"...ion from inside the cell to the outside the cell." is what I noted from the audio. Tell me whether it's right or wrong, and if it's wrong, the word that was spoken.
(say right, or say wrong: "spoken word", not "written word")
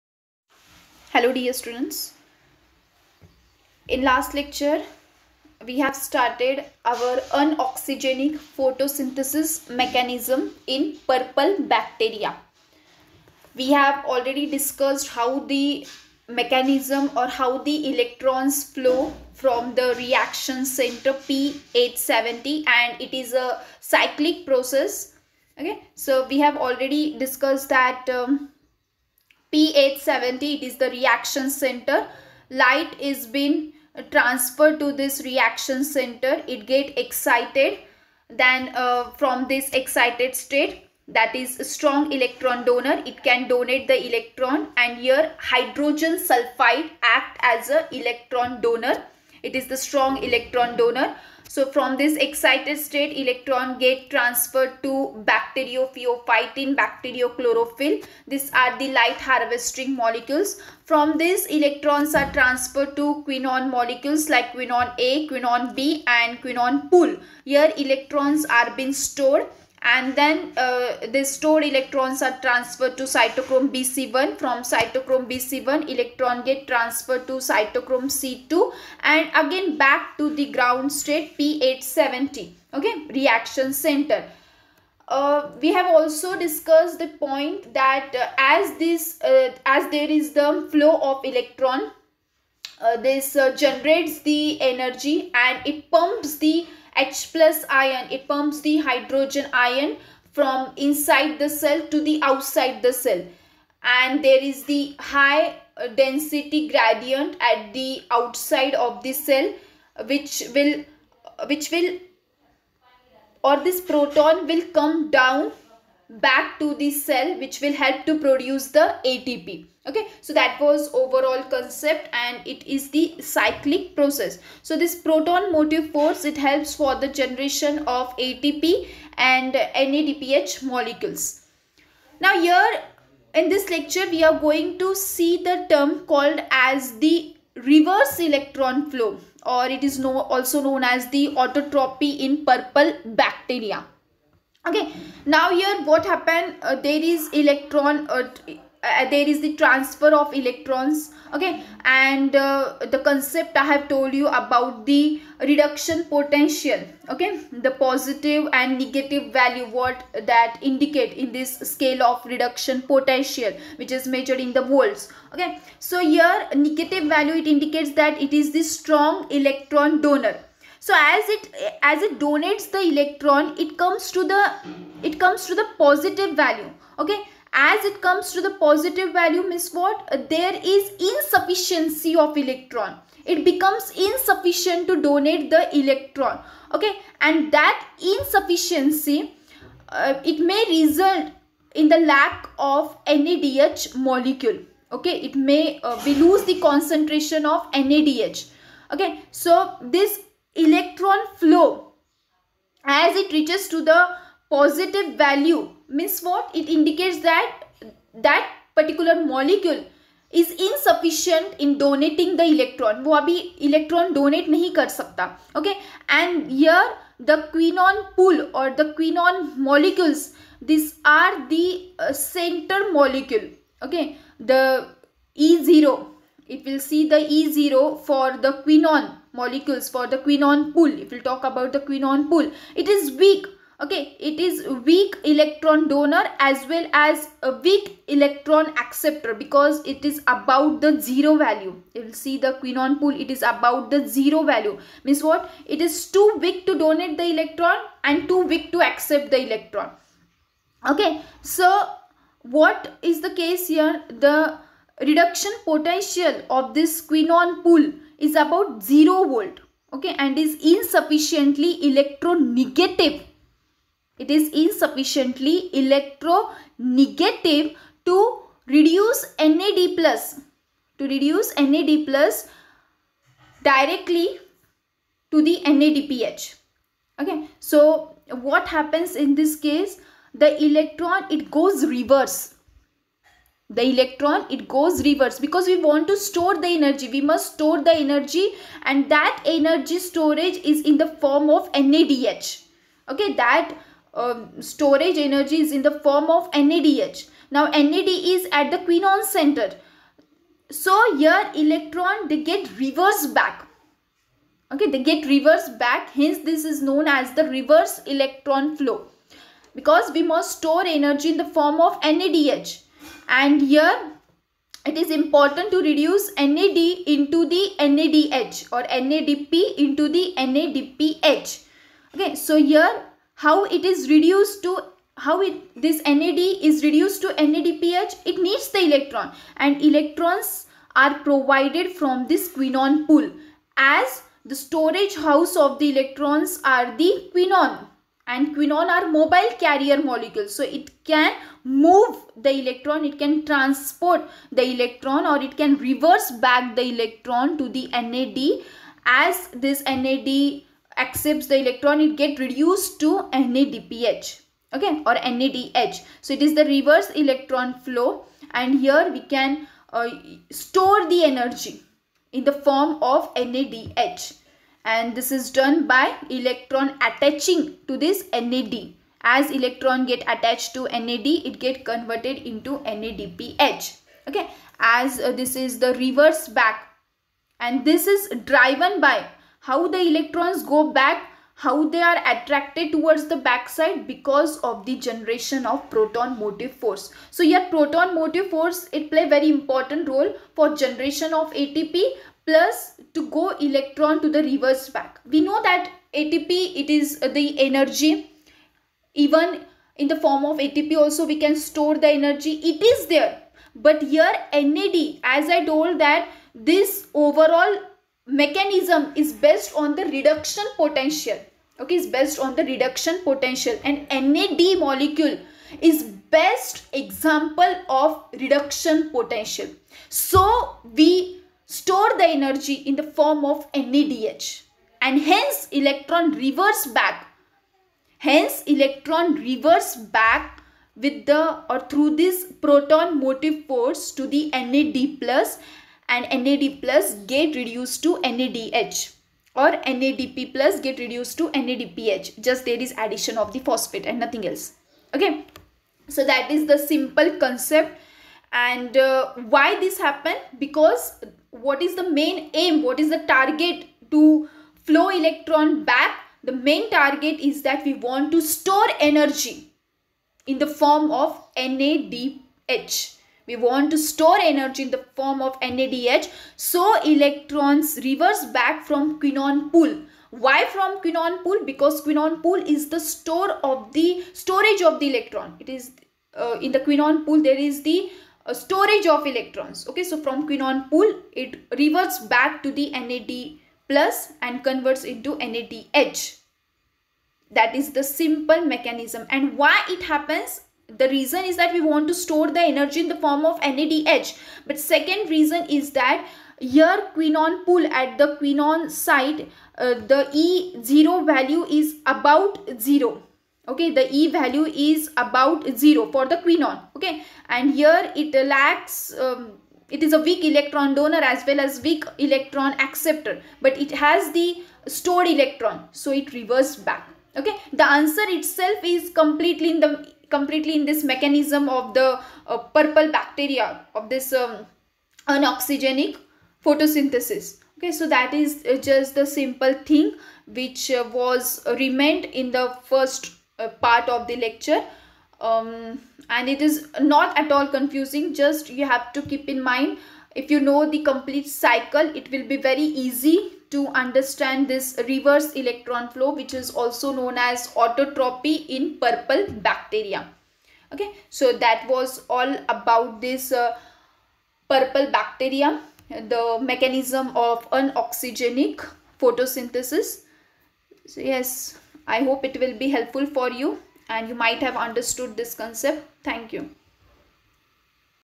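right.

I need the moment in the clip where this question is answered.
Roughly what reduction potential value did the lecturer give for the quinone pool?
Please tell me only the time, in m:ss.
4:18.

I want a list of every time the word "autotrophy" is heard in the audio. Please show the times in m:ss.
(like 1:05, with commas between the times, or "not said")
2:21, 9:07.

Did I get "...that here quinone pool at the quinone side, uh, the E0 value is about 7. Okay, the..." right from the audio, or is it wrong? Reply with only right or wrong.
wrong.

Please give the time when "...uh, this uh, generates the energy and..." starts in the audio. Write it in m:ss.
1:32.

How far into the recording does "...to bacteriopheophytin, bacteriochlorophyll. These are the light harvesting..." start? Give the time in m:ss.
0:54.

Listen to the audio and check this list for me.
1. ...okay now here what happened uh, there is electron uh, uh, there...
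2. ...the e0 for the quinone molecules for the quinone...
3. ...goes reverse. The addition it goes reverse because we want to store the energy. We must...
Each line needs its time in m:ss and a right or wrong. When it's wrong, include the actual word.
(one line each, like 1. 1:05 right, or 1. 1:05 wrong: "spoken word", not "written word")
1. 2:24 right
2. 3:47 right
3. 4:41 wrong: "electron", not "addition".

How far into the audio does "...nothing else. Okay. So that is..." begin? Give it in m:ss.
7:24.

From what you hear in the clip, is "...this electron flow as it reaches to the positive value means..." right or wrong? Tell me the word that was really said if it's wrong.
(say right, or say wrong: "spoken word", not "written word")
right.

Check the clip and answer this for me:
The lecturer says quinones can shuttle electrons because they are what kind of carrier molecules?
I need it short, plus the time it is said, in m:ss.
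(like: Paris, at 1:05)
mobile carrier molecules, at 5:39.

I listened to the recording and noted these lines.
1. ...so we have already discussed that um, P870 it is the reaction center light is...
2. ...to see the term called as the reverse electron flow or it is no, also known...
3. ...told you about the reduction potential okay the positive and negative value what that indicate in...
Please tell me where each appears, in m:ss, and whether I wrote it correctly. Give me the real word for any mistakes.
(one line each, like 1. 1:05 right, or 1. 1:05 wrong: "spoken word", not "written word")
1. 0:25 right
2. 2:14 right
3. 2:33 right.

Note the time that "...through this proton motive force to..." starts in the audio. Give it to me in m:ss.
7:11.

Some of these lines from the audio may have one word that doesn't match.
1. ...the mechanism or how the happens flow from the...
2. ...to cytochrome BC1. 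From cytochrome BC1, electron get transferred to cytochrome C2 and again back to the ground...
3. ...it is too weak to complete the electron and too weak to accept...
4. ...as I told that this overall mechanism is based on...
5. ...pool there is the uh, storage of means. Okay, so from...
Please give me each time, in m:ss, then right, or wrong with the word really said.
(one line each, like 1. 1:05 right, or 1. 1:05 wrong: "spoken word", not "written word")
1. 0:15 wrong: "electrons", not "happens"
2. 1:12 right
3. 4:05 wrong: "donate", not "complete"
4. 6:45 right
5. 7:57 wrong: "electrons", not "means".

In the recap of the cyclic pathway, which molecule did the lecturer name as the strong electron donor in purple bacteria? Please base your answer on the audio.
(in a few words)
hydrogen sulfide.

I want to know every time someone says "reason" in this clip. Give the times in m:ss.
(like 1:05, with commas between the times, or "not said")
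8:11, 8:15.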